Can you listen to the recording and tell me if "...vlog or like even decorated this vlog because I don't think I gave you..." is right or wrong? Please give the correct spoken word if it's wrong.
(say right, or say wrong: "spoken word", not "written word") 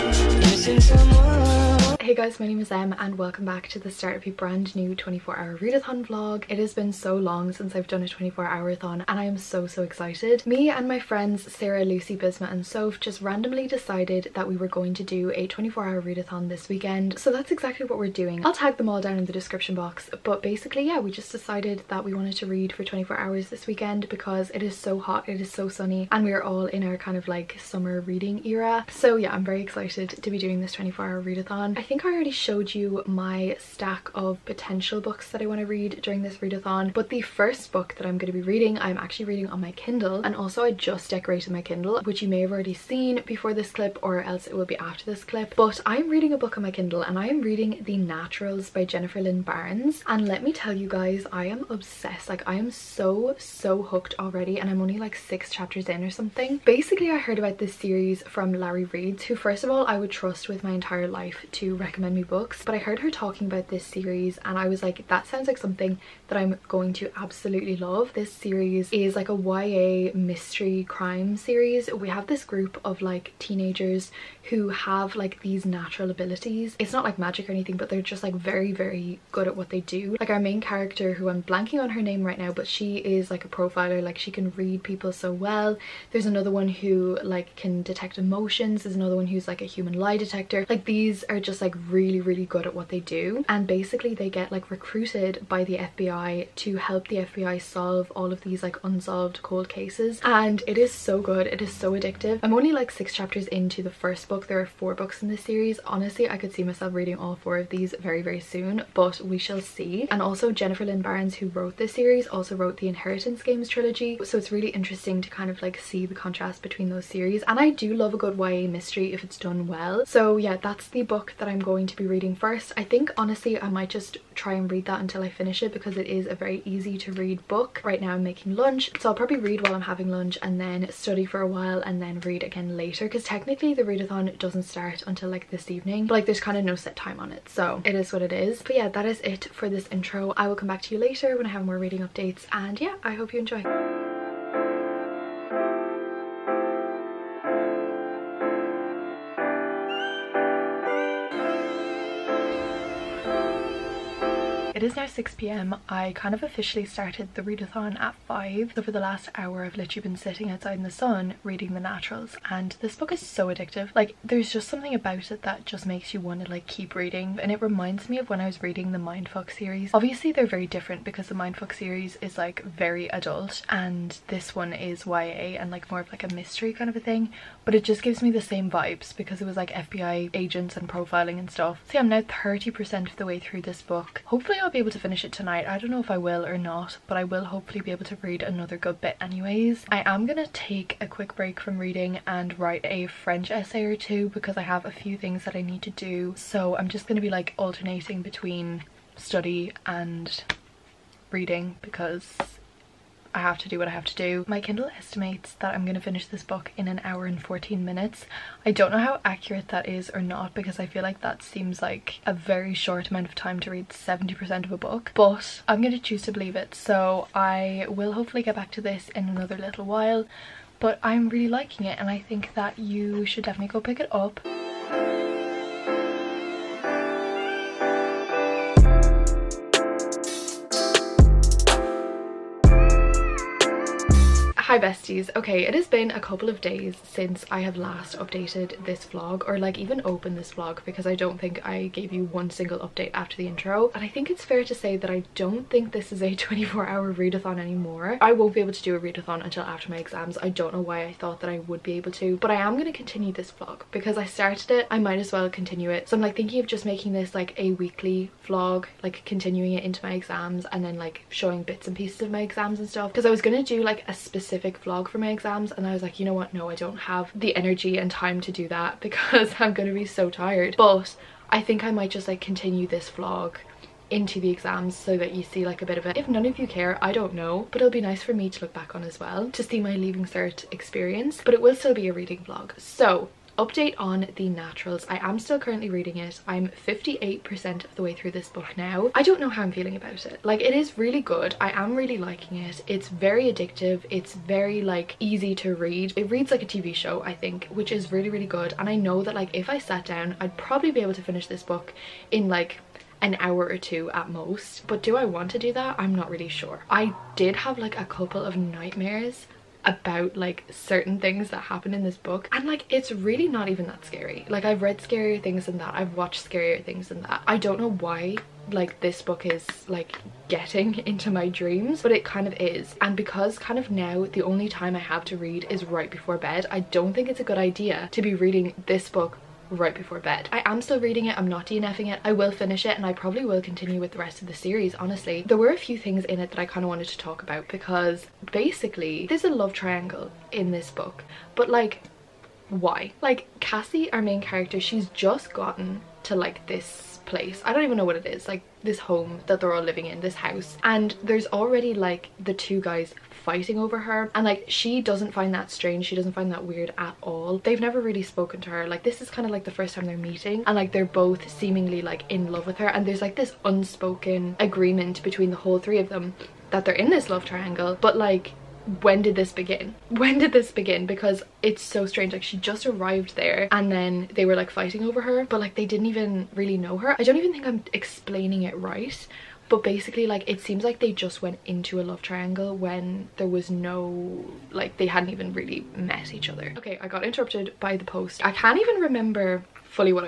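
wrong: "opened", not "decorated".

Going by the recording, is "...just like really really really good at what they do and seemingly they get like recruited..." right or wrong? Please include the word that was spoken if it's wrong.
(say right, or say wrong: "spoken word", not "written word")
wrong: "basically", not "seemingly".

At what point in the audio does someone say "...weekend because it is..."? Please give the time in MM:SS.
00:23.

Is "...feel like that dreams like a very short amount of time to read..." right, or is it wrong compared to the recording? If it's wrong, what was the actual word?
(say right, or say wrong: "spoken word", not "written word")
wrong: "seems", not "dreams".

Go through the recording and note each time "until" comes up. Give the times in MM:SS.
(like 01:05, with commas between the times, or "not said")
02:04, 02:15, 04:09.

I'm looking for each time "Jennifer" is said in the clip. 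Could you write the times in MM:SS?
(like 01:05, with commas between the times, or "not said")
00:48, 01:50.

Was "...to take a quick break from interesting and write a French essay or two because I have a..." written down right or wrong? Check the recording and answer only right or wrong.
wrong.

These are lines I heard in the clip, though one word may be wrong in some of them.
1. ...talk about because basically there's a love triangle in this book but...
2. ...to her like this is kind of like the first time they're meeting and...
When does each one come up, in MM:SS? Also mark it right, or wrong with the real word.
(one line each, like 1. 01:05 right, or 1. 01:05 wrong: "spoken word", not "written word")
1. 05:37 right
2. 05:58 right.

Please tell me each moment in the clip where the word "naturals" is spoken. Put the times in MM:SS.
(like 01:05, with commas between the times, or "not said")
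00:47, 01:15, 02:41, 04:44.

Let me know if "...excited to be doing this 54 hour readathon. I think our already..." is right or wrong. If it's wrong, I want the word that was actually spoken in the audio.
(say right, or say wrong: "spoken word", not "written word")
wrong: "24", not "54".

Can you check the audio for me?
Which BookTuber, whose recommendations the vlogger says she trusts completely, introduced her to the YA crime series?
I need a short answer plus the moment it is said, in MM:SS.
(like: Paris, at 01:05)
Larry Reads, at 00:58.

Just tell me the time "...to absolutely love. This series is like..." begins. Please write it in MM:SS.
01:06.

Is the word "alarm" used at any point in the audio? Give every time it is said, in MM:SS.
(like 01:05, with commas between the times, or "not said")
not said.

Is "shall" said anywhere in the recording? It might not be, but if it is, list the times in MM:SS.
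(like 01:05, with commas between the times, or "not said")
01:49.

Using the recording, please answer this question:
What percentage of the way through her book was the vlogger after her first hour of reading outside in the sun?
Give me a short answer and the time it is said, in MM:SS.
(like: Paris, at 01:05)
30%, at 03:02.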